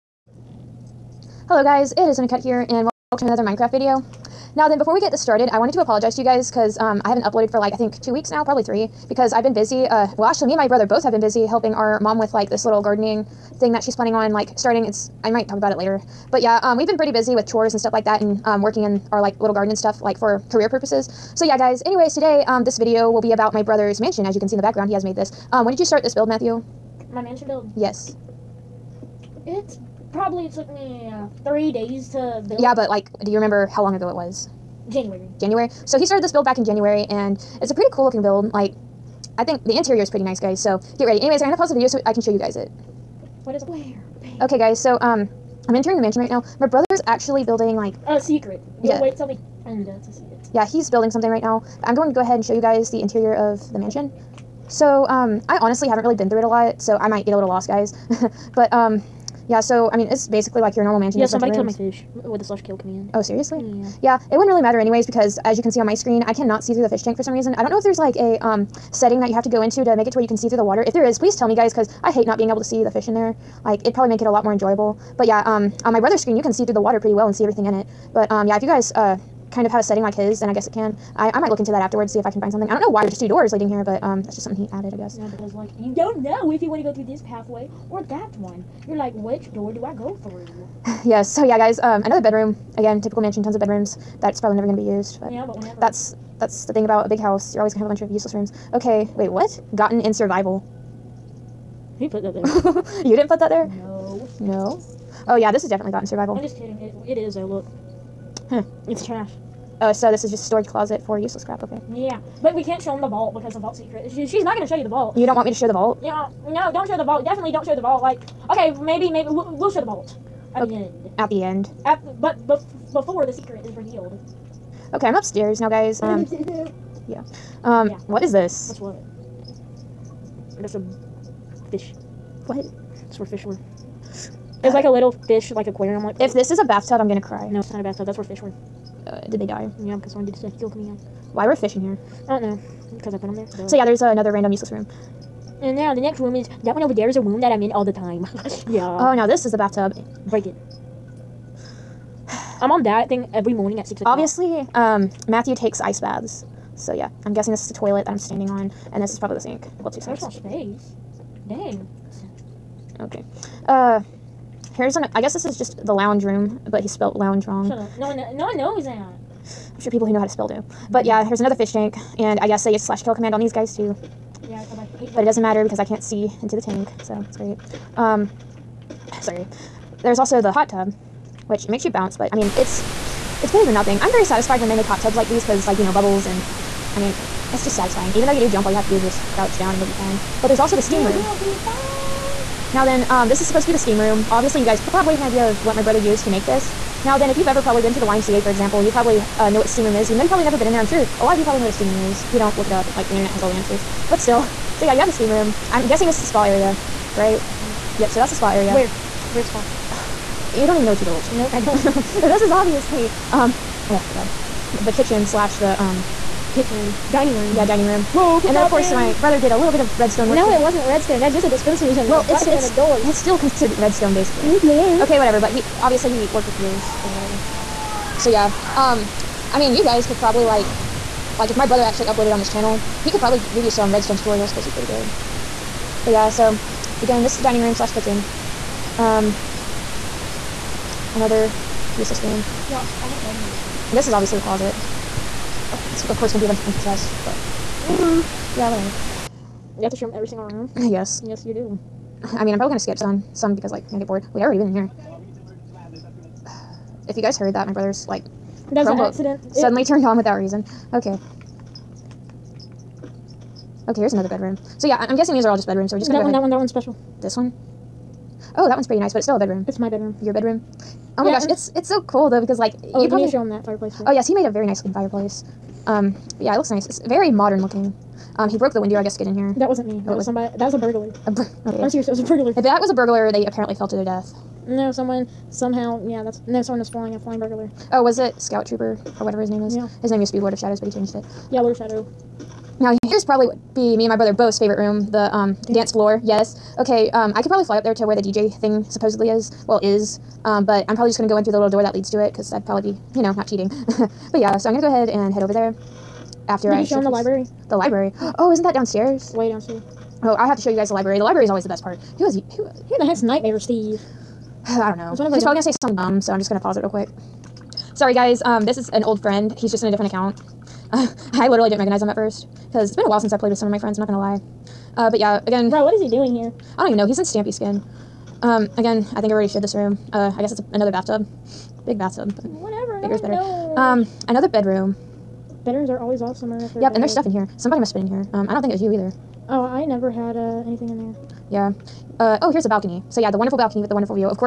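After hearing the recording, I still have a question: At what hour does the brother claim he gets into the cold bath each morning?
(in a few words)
6 o'clock.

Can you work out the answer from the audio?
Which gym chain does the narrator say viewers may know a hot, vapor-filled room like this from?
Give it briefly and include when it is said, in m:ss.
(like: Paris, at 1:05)
YMCA, at 3:18.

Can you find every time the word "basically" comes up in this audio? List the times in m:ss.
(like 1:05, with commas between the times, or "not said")
1:00, 3:44.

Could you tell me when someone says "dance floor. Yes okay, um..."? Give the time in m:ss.
4:55.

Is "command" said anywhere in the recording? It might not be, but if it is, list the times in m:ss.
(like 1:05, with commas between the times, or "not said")
1:02, 2:53.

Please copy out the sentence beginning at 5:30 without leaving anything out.
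Uh, I guess it's a, another bathtub.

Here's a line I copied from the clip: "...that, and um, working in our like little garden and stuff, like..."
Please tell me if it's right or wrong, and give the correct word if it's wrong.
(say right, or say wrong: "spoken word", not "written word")
right.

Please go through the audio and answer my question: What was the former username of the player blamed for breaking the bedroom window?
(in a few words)
Lord of Shadows.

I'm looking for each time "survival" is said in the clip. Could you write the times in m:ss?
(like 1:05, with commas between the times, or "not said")
1:40, 1:46.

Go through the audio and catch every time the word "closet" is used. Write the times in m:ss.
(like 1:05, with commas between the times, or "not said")
1:50, 4:04.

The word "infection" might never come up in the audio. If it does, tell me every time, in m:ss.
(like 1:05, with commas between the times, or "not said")
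not said.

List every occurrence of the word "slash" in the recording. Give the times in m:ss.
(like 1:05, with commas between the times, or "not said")
1:02, 2:52, 3:35, 3:57.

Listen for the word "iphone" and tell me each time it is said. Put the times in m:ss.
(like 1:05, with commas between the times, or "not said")
not said.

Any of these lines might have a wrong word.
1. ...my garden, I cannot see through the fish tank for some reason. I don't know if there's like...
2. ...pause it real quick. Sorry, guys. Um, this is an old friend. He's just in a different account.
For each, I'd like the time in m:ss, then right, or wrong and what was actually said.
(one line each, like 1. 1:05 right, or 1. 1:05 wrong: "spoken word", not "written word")
1. 1:05 wrong: "screen", not "garden"
2. 5:16 right.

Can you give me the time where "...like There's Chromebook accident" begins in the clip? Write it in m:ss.
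4:18.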